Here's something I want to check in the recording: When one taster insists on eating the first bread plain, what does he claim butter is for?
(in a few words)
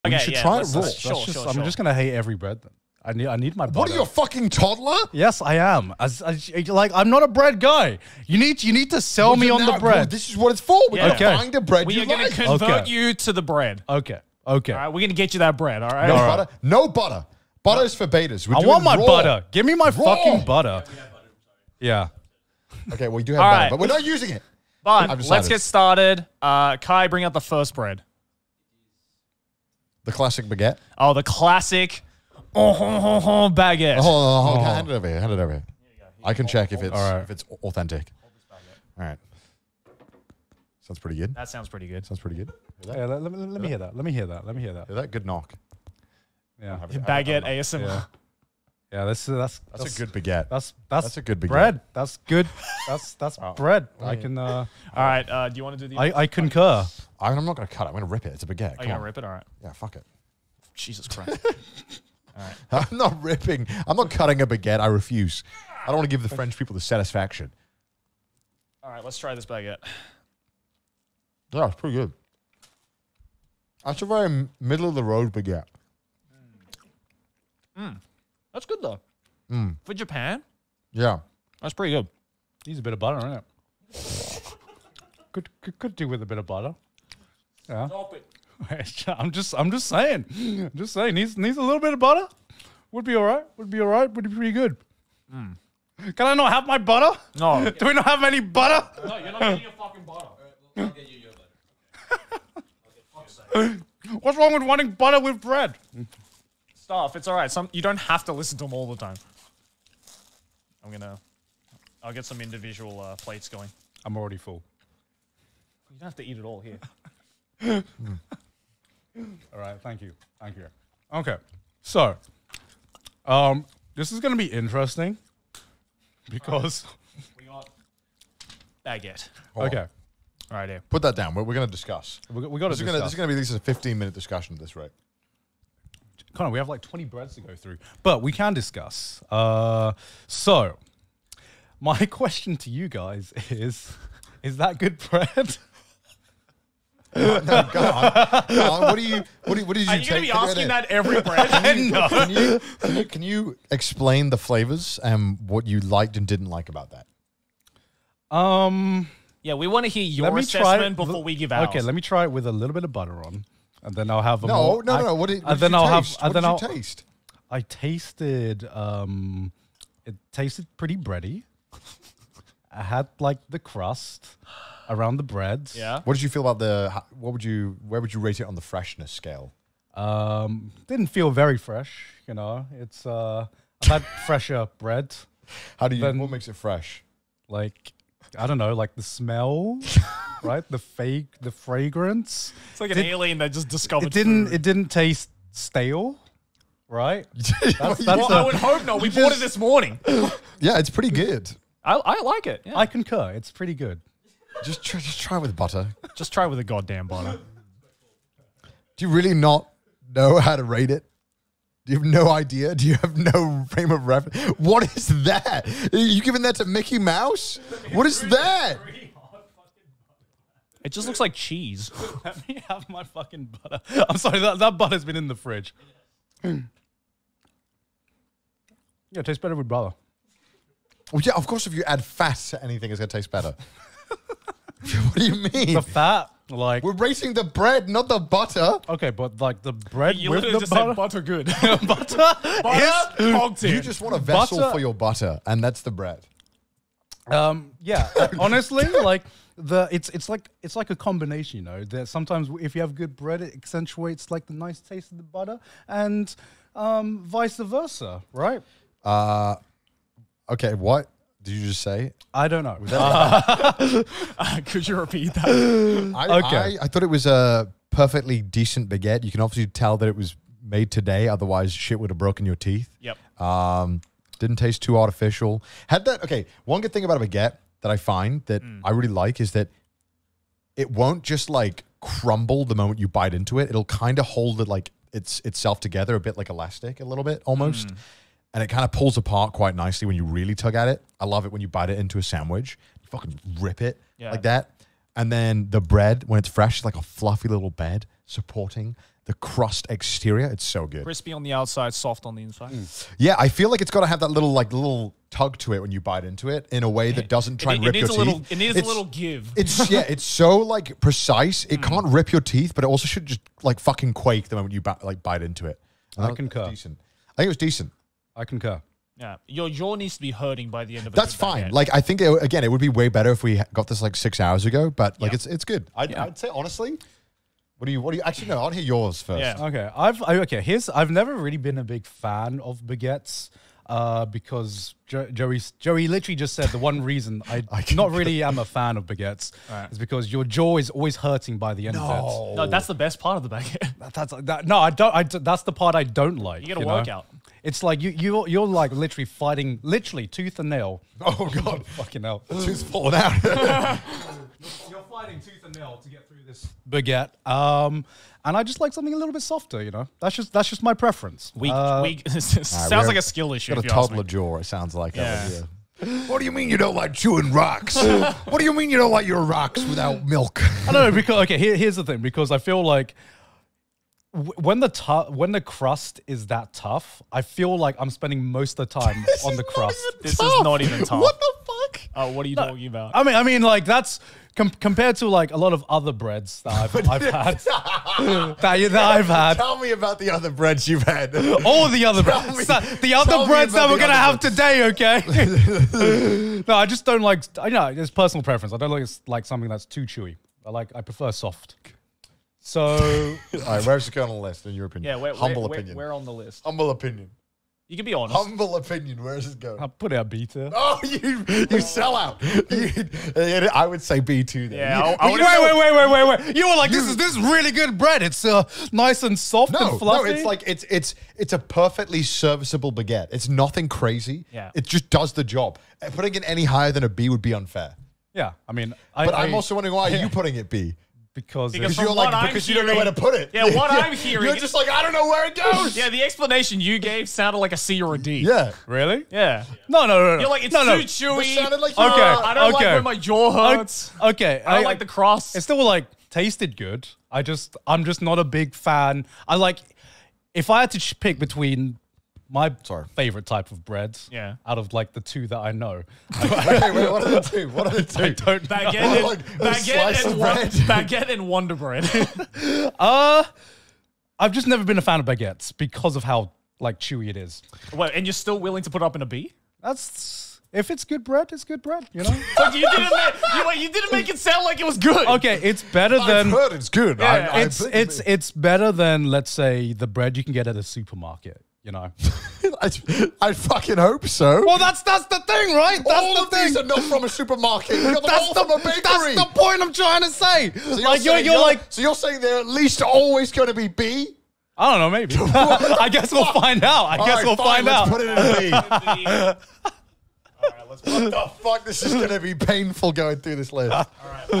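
betas.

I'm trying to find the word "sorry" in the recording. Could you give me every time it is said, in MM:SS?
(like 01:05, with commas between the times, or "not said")
03:44, 07:32.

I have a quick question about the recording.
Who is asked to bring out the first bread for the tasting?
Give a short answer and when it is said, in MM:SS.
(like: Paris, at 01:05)
Kai, at 00:26.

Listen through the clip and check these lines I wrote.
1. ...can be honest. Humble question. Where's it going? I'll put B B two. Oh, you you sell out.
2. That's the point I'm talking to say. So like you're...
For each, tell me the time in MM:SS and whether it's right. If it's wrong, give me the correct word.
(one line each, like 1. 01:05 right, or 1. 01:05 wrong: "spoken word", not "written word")
1. 06:47 wrong: "opinion", not "question"
2. 08:09 wrong: "trying", not "talking".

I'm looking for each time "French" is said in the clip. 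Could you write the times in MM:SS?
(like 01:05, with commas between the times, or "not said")
01:06.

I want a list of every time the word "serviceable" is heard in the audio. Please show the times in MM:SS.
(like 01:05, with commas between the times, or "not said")
07:02.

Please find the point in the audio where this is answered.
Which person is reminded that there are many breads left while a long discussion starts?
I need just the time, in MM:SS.
02:16.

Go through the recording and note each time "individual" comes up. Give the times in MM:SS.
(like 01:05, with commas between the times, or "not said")
01:52.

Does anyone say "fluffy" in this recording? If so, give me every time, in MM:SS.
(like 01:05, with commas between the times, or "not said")
04:57, 06:59.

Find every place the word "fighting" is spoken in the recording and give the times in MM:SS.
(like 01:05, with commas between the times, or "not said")
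05:49, 05:55.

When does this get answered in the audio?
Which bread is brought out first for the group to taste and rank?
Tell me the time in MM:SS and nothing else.
00:30.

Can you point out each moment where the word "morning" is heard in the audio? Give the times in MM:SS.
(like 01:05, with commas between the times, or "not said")
03:19.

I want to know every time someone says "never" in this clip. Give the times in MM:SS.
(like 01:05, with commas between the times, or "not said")
05:31, 07:44.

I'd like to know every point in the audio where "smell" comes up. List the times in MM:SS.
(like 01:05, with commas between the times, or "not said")
03:09.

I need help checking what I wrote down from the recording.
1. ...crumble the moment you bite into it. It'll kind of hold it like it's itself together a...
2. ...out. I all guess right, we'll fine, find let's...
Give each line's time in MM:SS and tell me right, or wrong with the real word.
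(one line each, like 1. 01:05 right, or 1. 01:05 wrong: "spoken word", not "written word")
1. 04:42 right
2. 08:16 right.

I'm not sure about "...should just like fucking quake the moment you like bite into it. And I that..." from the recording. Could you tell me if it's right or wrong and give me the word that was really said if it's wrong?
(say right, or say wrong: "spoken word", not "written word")
right.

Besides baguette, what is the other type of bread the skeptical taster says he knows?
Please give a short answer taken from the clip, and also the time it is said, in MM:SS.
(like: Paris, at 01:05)
Wonder Bread, at 07:41.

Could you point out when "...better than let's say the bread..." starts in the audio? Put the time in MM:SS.
07:58.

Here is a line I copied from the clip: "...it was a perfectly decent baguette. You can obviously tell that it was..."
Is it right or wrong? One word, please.
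right.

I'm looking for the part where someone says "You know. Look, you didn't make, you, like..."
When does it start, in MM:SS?
07:52.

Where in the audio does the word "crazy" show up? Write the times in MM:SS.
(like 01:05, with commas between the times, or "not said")
07:03.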